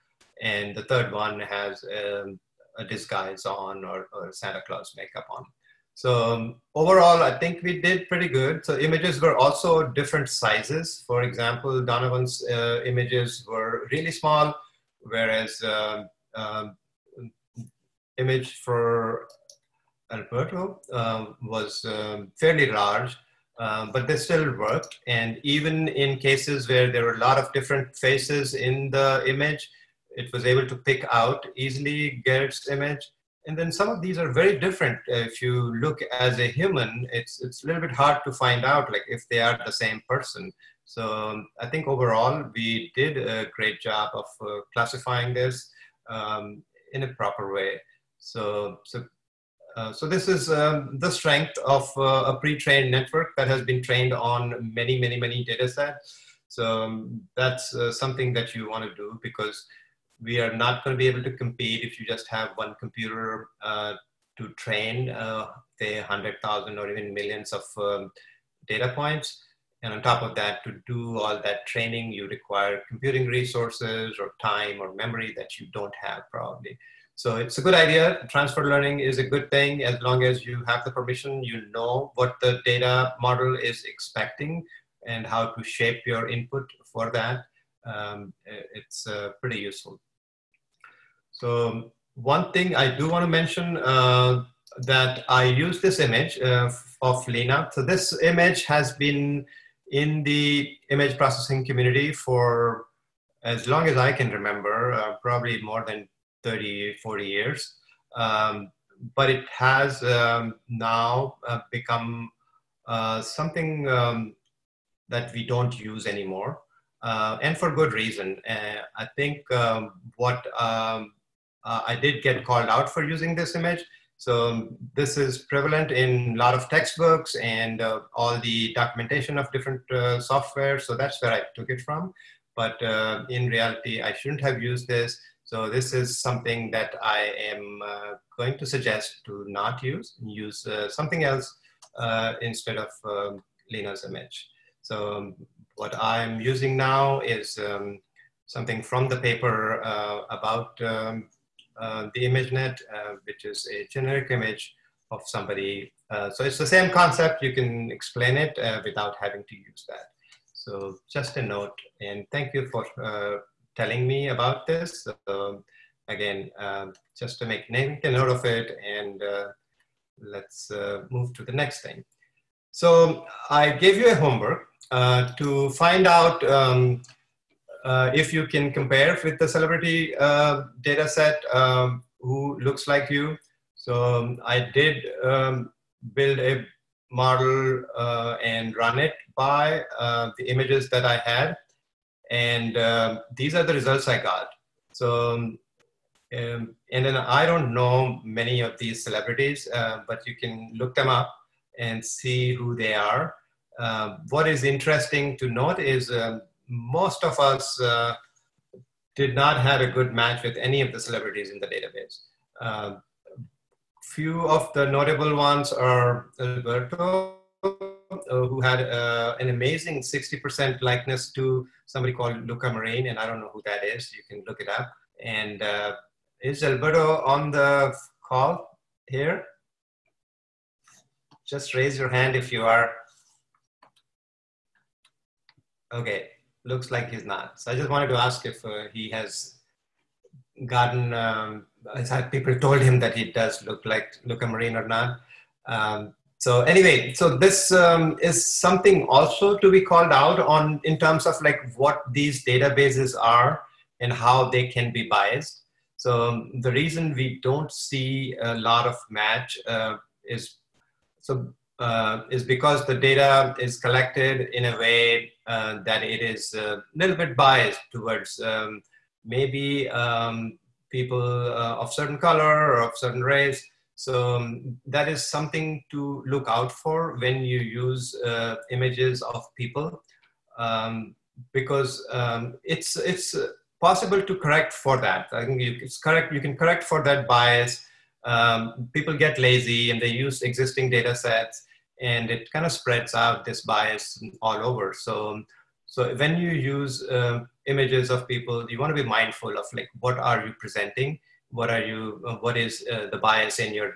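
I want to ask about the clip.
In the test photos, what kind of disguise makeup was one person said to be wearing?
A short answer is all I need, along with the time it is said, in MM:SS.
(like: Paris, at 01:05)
Santa Claus, at 00:04.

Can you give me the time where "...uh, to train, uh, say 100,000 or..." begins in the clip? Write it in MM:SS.
01:03.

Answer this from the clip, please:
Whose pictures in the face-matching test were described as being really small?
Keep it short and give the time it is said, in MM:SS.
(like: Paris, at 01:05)
Donovan, at 00:11.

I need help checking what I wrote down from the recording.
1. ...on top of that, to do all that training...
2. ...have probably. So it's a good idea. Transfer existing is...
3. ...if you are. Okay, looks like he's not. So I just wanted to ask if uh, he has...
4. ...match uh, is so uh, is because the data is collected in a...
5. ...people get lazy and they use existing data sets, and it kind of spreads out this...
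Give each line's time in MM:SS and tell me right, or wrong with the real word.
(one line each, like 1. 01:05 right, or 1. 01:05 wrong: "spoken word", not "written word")
1. 01:09 right
2. 01:16 wrong: "learning", not "existing"
3. 03:52 right
4. 04:19 right
5. 04:48 right.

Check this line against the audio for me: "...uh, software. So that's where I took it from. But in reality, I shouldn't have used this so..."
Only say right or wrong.
right.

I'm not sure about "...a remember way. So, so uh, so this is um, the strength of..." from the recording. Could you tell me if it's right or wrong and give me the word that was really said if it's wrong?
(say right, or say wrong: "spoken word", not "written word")
wrong: "proper", not "remember".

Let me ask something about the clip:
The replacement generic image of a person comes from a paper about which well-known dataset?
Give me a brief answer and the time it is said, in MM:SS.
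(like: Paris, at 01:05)
ImageNet, at 02:32.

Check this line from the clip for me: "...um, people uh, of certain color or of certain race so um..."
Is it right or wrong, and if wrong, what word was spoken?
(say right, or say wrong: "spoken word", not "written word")
right.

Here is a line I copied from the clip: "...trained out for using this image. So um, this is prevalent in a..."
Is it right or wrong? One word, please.
wrong.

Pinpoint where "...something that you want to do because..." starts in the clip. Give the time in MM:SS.
00:57.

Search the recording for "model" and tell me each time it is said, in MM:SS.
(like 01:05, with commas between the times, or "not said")
01:23, 03:07.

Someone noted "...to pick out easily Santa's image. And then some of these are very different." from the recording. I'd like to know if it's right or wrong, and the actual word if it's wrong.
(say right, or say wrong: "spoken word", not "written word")
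wrong: "Garrett", not "Santa".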